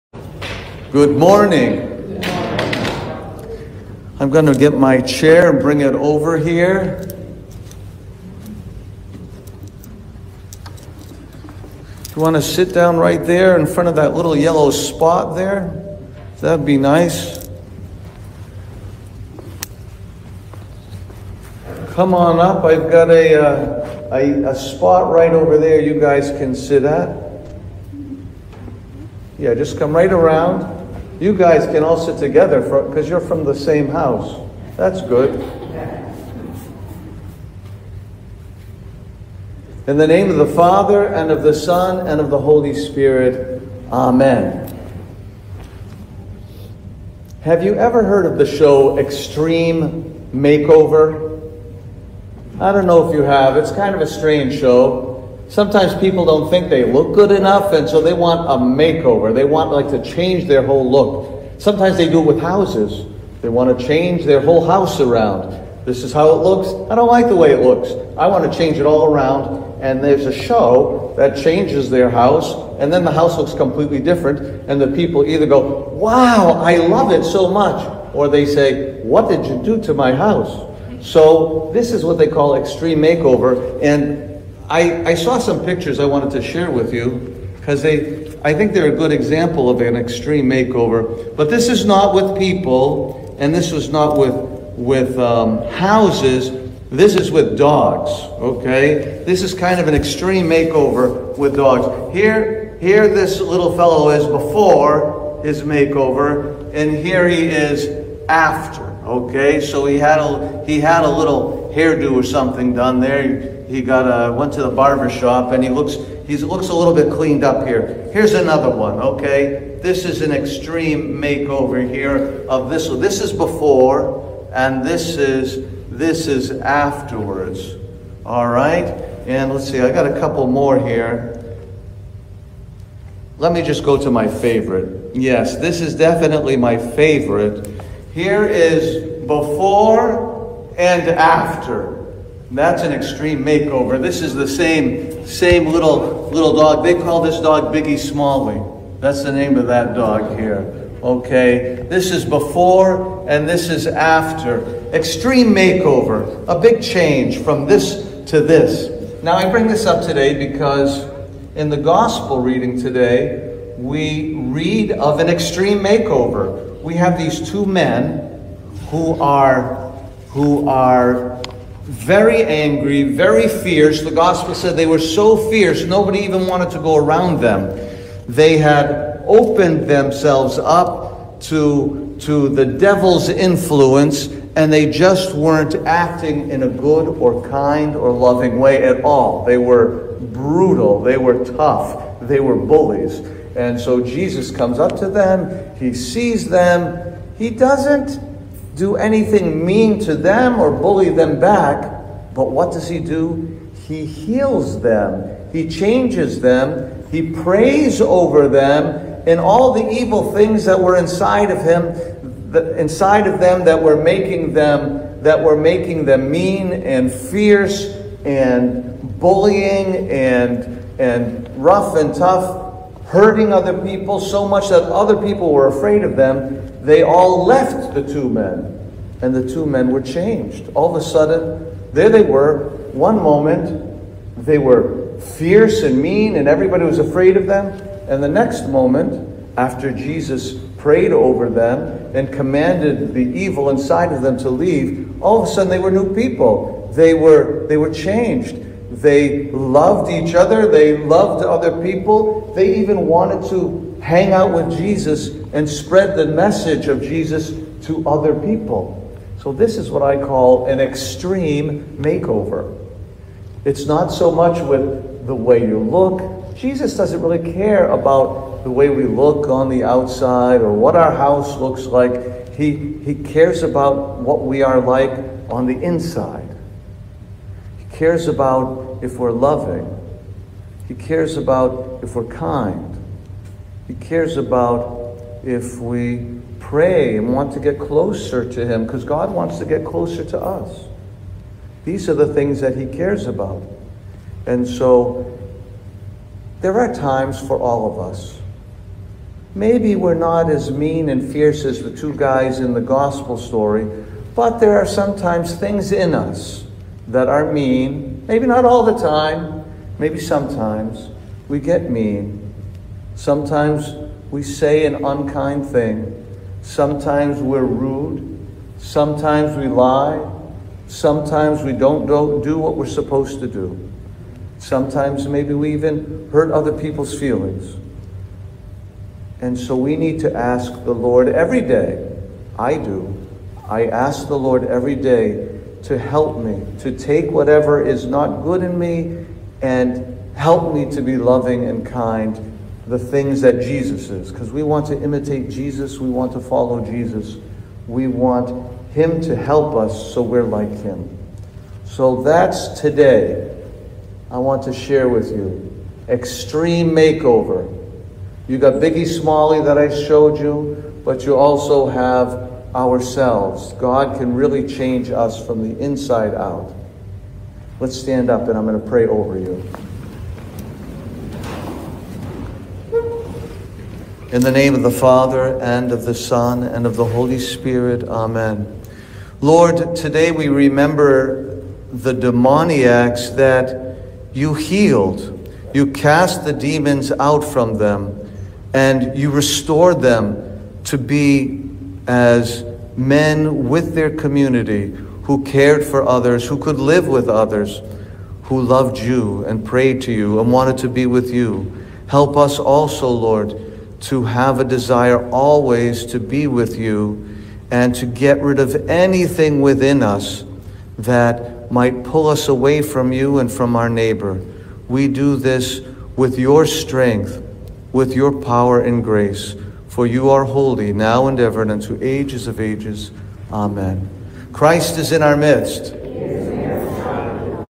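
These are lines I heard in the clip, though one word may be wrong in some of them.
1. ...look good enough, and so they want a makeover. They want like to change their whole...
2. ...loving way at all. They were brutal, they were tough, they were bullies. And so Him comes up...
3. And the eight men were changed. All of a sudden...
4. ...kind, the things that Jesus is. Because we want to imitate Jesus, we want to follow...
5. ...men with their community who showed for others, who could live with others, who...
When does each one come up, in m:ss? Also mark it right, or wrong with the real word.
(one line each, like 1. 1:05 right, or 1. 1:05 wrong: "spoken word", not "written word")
1. 0:56 right
2. 3:08 wrong: "Jesus", not "Him"
3. 3:49 wrong: "two", not "eight"
4. 5:41 right
5. 6:32 wrong: "cared", not "showed".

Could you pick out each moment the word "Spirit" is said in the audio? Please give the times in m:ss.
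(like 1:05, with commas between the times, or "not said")
0:42, 6:17.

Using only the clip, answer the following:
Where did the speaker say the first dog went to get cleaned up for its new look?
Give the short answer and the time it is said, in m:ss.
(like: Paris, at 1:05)
the barber shop, at 1:54.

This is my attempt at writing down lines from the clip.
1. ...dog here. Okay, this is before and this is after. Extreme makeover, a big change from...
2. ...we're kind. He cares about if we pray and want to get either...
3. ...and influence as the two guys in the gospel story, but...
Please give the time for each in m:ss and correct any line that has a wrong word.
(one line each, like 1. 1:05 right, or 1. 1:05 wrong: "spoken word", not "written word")
1. 2:29 right
2. 4:42 wrong: "closer", not "either"
3. 5:01 wrong: "fierce", not "influence".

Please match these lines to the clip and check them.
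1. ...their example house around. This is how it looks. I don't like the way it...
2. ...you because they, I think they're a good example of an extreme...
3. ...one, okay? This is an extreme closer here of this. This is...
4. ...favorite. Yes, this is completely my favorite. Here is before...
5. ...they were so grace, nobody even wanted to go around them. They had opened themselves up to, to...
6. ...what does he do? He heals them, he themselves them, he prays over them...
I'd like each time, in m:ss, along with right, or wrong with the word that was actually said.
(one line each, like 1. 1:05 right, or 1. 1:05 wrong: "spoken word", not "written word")
1. 1:04 wrong: "whole", not "example"
2. 1:26 right
3. 1:58 wrong: "makeover", not "closer"
4. 2:14 wrong: "definitely", not "completely"
5. 2:54 wrong: "fierce", not "grace"
6. 3:22 wrong: "changes", not "themselves".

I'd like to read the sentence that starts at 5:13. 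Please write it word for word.
Sometimes we say an unkind thing.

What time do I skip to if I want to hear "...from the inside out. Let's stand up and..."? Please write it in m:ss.
6:05.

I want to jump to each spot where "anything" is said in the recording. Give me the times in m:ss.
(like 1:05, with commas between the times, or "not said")
3:18, 6:48.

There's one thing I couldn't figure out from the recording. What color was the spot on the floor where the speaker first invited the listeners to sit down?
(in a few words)
yellow.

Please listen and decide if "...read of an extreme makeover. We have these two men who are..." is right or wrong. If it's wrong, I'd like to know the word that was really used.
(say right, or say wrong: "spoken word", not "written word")
right.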